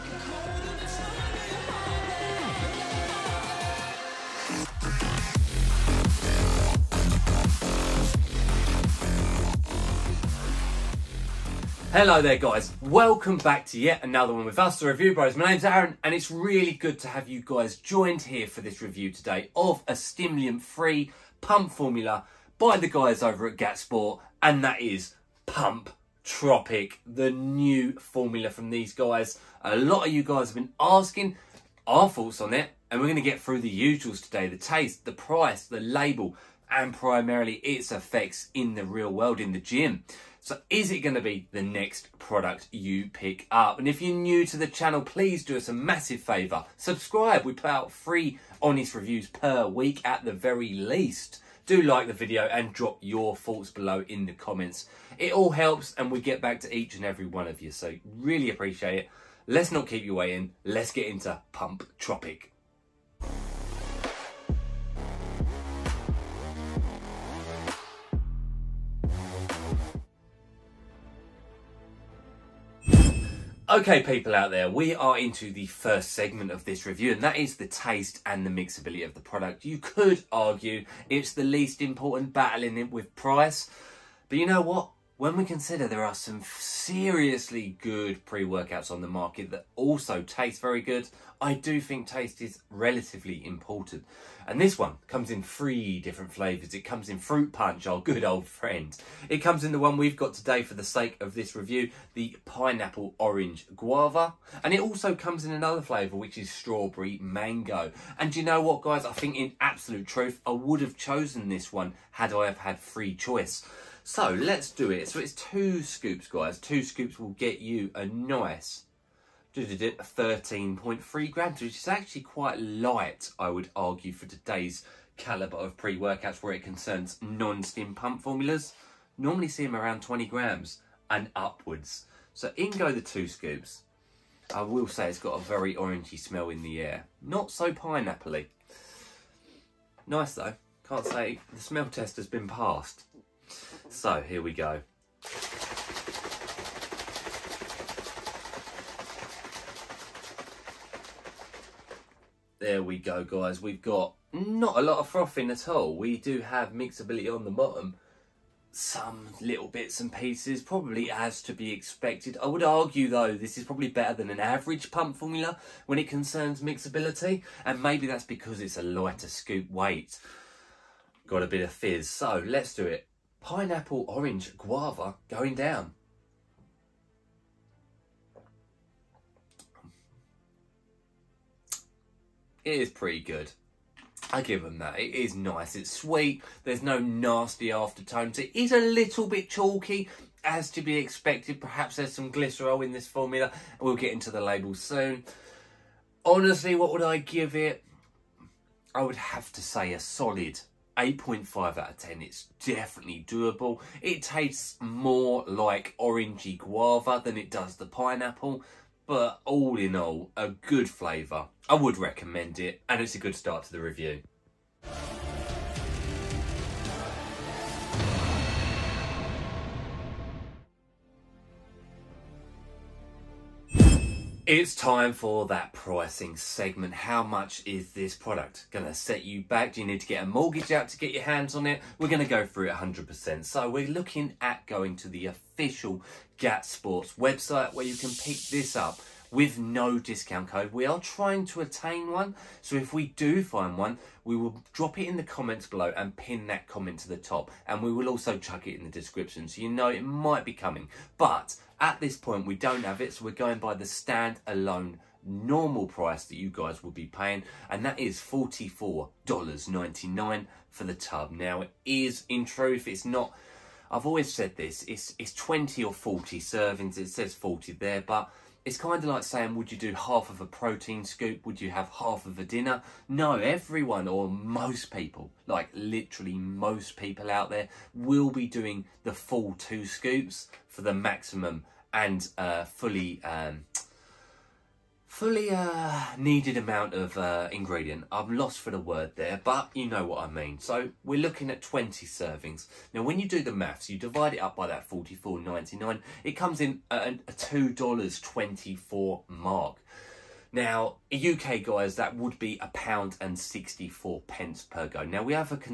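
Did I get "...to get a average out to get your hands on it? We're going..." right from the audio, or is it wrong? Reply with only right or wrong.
wrong.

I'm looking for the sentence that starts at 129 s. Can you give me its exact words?
Normally see them around 20 grams and upwards.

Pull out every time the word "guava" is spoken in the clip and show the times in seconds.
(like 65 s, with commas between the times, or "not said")
103 s, 174 s, 206 s.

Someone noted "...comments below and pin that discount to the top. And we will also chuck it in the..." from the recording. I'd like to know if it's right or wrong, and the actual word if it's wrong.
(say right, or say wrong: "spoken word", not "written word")
wrong: "comment", not "discount".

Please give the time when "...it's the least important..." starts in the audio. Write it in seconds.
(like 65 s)
81 s.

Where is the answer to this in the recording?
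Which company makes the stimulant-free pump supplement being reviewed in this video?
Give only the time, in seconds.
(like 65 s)
23 s.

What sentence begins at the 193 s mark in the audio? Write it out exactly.
We'll get into the label soon.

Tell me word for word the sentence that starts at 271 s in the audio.
Would you have half of a dinner?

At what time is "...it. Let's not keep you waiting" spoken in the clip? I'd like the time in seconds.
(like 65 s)
58 s.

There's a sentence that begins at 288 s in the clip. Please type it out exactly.
I'm lost for the word there, but you know what I mean.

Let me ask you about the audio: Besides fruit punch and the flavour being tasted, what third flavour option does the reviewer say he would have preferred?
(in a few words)
Strawberry Mango.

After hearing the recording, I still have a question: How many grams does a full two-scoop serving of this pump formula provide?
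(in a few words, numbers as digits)
13.3 grams.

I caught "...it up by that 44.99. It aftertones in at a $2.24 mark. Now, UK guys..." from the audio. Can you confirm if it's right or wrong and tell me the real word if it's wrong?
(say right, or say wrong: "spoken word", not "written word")
wrong: "comes", not "aftertones".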